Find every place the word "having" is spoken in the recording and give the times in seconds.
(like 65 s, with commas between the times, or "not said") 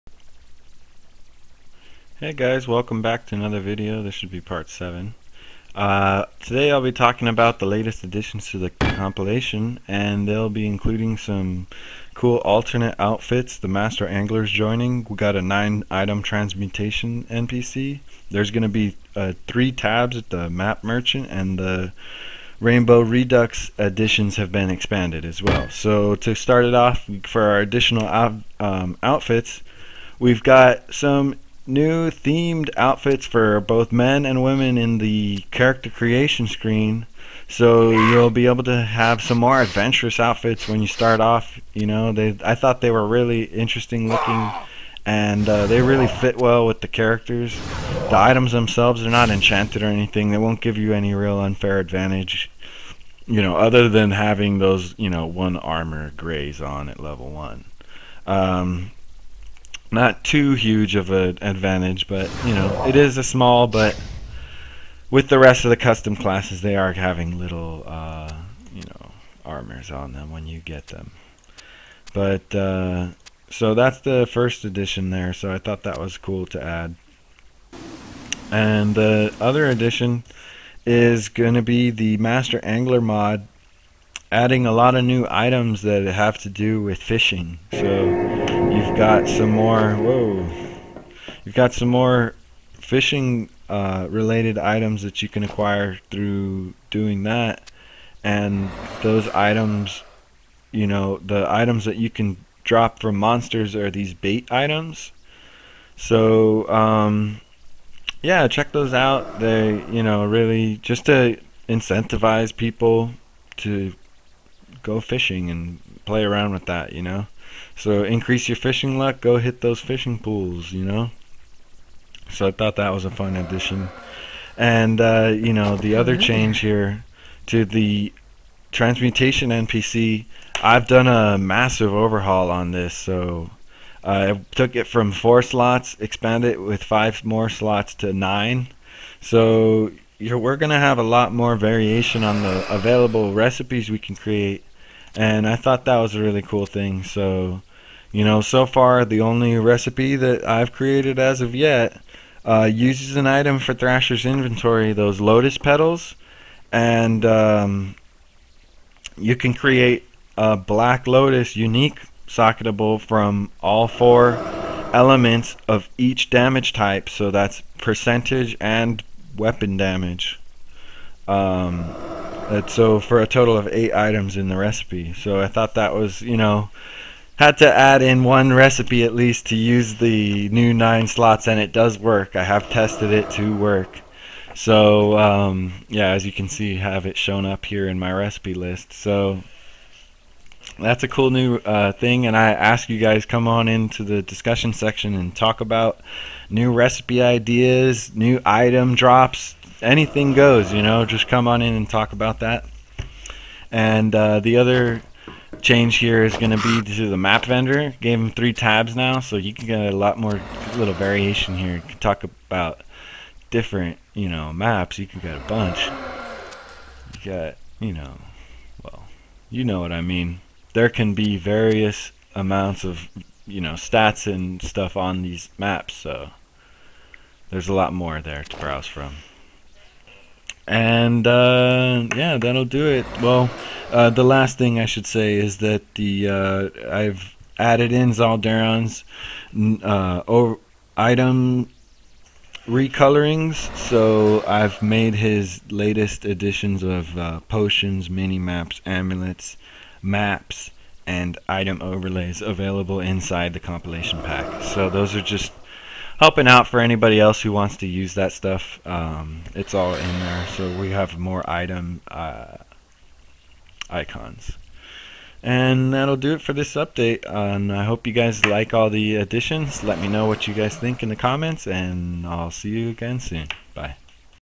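54 s, 66 s.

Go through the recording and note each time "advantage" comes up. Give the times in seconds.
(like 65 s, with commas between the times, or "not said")
51 s, 61 s.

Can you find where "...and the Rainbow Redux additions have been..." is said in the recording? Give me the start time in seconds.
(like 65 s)
21 s.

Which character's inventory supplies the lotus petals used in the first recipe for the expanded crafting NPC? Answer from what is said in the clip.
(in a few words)
Thrasher.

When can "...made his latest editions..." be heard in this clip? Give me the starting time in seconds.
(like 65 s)
244 s.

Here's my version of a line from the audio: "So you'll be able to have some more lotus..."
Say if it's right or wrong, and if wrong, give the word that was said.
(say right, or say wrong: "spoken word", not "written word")
wrong: "adventurous", not "lotus".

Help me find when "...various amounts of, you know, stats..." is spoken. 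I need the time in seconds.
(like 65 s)
221 s.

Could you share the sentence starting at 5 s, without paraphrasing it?
Uh, today I'll be talking about the latest additions to the compilation and they'll be including some cool alternate outfits.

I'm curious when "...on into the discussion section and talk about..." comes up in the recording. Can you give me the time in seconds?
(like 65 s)
193 s.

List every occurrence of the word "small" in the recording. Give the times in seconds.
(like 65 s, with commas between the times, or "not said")
63 s.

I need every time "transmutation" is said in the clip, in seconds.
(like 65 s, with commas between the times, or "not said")
16 s, 128 s.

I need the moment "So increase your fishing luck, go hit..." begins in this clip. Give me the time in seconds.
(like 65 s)
117 s.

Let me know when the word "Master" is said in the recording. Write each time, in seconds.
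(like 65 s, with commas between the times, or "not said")
13 s, 82 s.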